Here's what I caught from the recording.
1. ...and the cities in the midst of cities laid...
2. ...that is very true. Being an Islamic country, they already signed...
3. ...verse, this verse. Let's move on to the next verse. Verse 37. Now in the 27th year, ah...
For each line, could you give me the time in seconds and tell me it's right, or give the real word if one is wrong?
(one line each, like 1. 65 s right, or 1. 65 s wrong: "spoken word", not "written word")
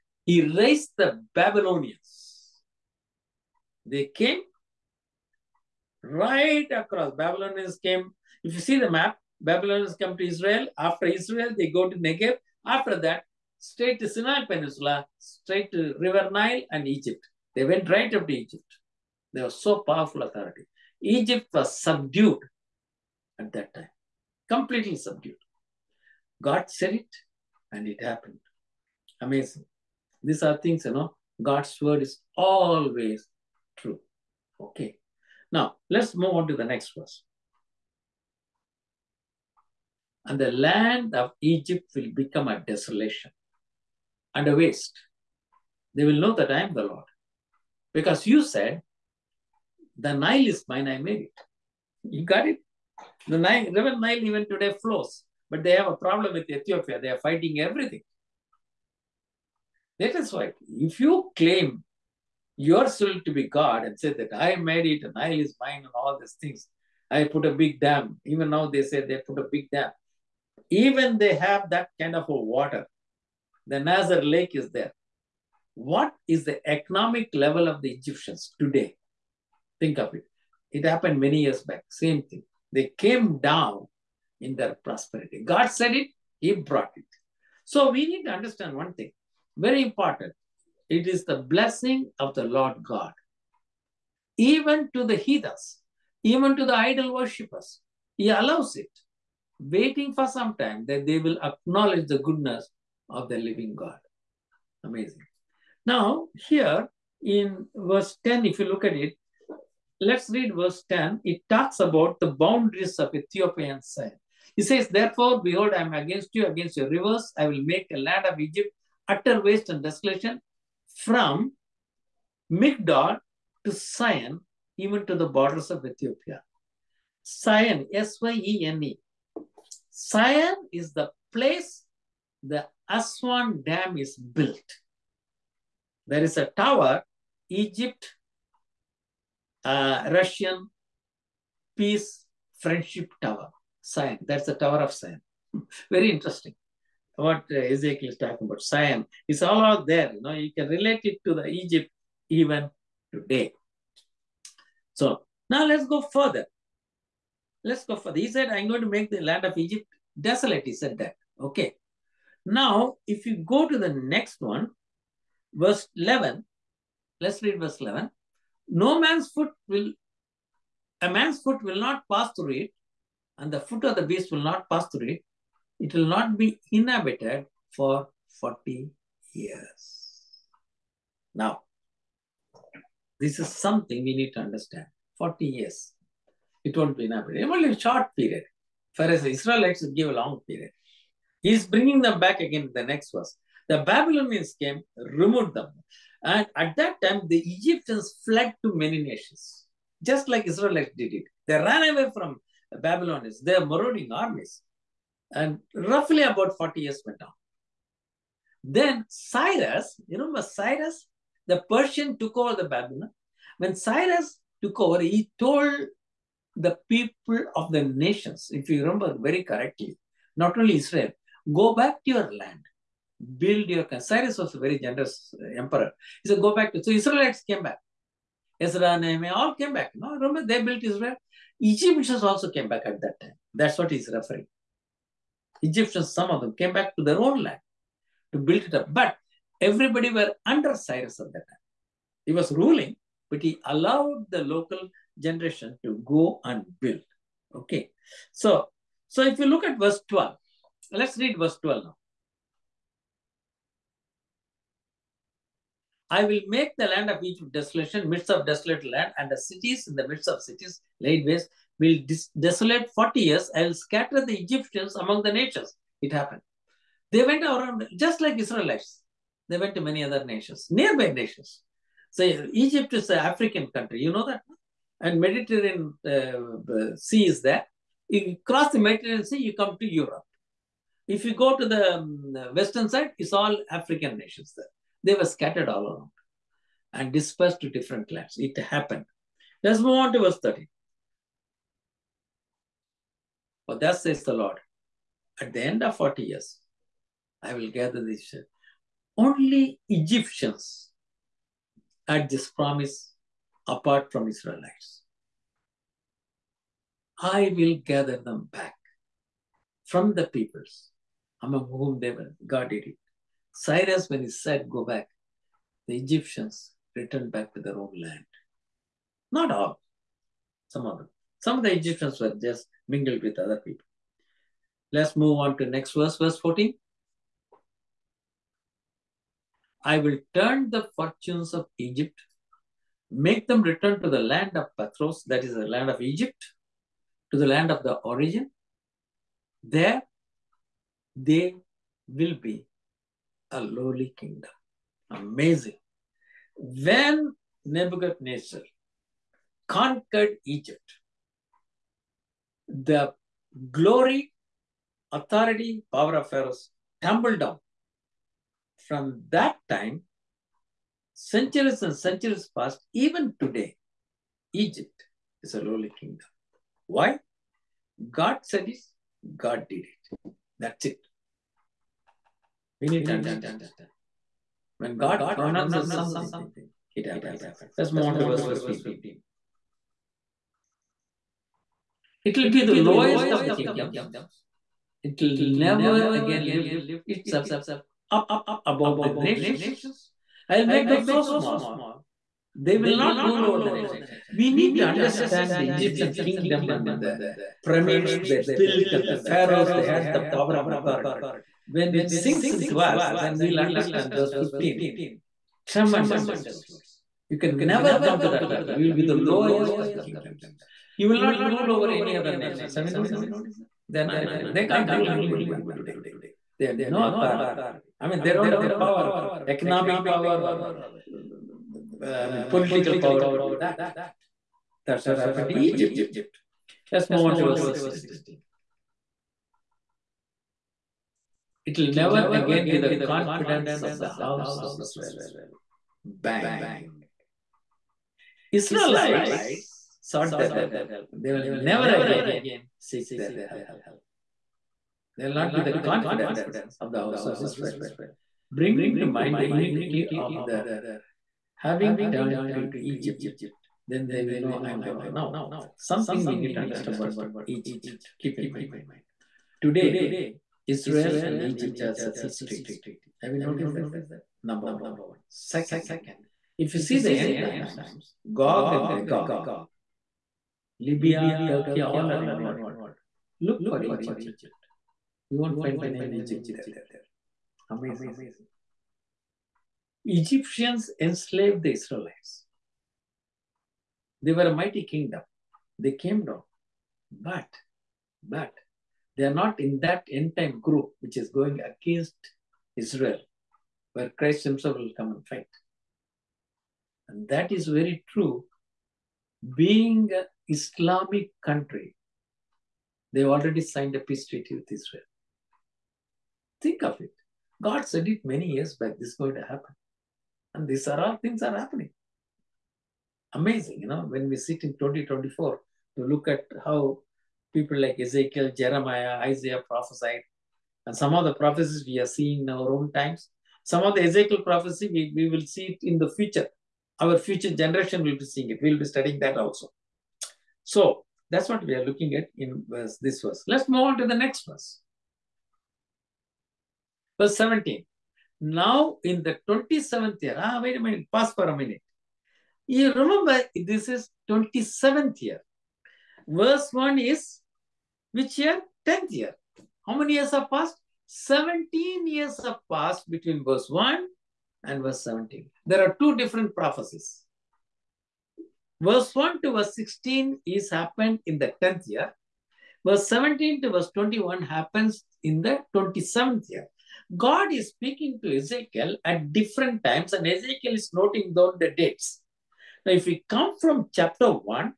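1. 259 s right
2. 497 s right
3. 532 s wrong: "17", not "37".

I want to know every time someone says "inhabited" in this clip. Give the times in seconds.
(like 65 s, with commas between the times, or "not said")
176 s, 187 s.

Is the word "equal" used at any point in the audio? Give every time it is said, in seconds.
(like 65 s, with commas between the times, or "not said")
not said.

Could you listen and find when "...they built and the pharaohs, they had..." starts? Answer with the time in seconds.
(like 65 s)
398 s.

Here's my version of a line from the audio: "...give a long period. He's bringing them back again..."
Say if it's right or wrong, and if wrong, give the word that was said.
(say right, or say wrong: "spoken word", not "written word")
right.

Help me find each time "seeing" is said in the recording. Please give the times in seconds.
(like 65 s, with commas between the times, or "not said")
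522 s, 528 s.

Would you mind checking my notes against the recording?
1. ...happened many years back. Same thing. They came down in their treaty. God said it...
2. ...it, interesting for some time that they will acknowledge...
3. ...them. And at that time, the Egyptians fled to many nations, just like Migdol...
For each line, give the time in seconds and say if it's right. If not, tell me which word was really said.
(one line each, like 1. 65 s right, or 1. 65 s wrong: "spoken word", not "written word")
1. 80 s wrong: "prosperity", not "treaty"
2. 98 s wrong: "waiting", not "interesting"
3. 195 s wrong: "Israelites", not "Migdol".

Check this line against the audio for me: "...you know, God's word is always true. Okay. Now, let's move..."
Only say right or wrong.
right.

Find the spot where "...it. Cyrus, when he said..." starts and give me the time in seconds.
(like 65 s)
312 s.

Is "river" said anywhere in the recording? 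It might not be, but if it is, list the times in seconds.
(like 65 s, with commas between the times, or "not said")
15 s, 53 s, 116 s.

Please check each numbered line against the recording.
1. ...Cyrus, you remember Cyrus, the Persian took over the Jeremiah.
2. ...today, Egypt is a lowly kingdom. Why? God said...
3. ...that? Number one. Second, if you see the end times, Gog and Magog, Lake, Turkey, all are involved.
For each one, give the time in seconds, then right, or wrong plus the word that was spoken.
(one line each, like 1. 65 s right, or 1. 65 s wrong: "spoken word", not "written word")
1. 209 s wrong: "Babylon", not "Jeremiah"
2. 363 s right
3. 463 s wrong: "Libya", not "Lake".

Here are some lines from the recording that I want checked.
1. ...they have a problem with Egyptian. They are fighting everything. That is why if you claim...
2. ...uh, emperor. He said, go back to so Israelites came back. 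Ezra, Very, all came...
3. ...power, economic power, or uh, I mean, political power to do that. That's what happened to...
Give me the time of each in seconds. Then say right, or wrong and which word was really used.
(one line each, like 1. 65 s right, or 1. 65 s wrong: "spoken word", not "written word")
1. 55 s wrong: "Ethiopia", not "Egyptian"
2. 225 s wrong: "Nehemiah", not "Very"
3. 418 s right.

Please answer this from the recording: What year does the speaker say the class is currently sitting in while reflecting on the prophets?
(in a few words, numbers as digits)
2024.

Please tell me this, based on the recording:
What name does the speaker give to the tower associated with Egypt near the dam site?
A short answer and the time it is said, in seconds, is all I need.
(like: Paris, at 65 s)
Russian Peace Friendship Tower, at 140 s.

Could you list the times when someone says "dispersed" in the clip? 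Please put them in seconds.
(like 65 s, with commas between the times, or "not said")
287 s.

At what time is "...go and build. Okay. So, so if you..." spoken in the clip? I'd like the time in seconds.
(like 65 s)
246 s.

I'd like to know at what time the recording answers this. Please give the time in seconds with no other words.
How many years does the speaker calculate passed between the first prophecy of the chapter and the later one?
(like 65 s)
551 s.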